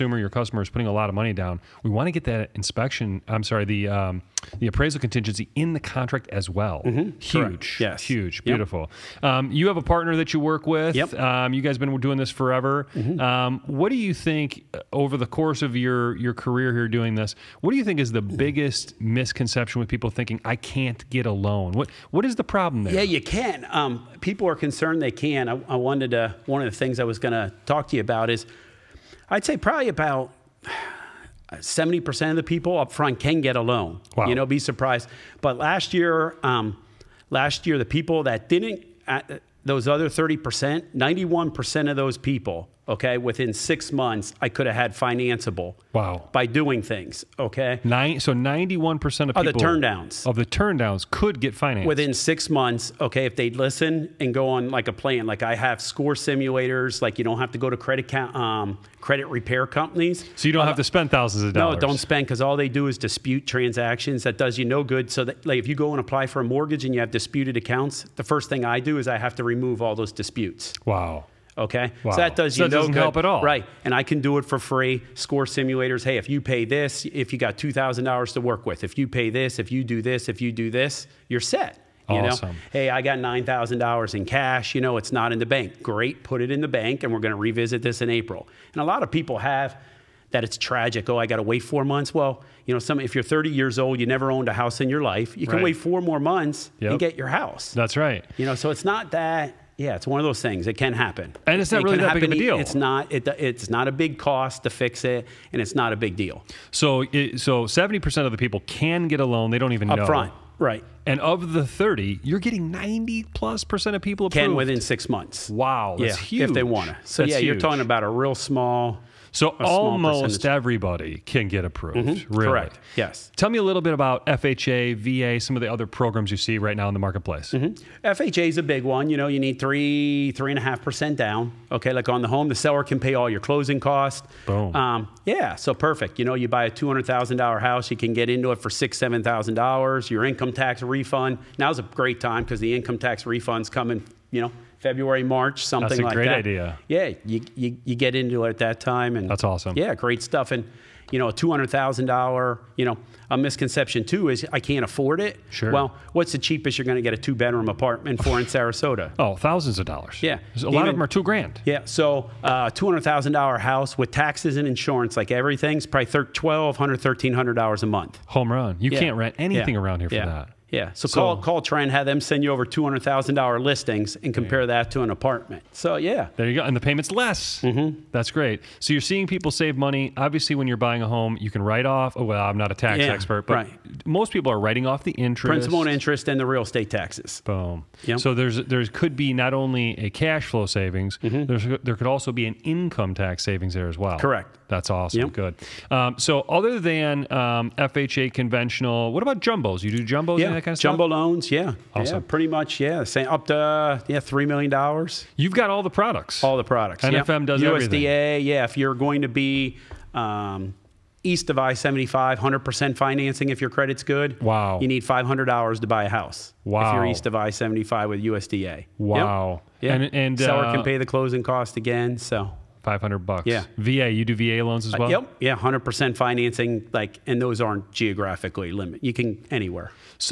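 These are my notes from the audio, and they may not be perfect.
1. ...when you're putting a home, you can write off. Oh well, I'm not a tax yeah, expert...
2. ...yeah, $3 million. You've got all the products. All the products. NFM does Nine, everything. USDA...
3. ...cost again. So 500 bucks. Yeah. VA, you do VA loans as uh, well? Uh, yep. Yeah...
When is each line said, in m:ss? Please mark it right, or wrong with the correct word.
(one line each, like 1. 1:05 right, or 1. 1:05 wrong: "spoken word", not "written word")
1. 3:00 wrong: "buying", not "putting"
2. 3:24 wrong: "USDA", not "Nine"
3. 3:41 right.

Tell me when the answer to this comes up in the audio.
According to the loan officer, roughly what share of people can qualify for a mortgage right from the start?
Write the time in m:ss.
0:31.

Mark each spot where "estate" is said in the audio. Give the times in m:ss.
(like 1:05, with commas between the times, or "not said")
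3:06.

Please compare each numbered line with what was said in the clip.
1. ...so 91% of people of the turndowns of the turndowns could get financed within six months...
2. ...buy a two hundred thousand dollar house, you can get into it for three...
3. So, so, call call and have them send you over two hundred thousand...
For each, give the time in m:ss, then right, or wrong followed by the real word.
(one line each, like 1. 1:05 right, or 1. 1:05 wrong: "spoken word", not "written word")
1. 0:48 right
2. 2:16 wrong: "six", not "three"
3. 2:50 right.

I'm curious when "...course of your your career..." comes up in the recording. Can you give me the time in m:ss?
0:15.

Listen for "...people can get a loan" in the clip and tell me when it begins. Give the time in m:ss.
1:48.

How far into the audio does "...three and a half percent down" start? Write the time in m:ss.
2:10.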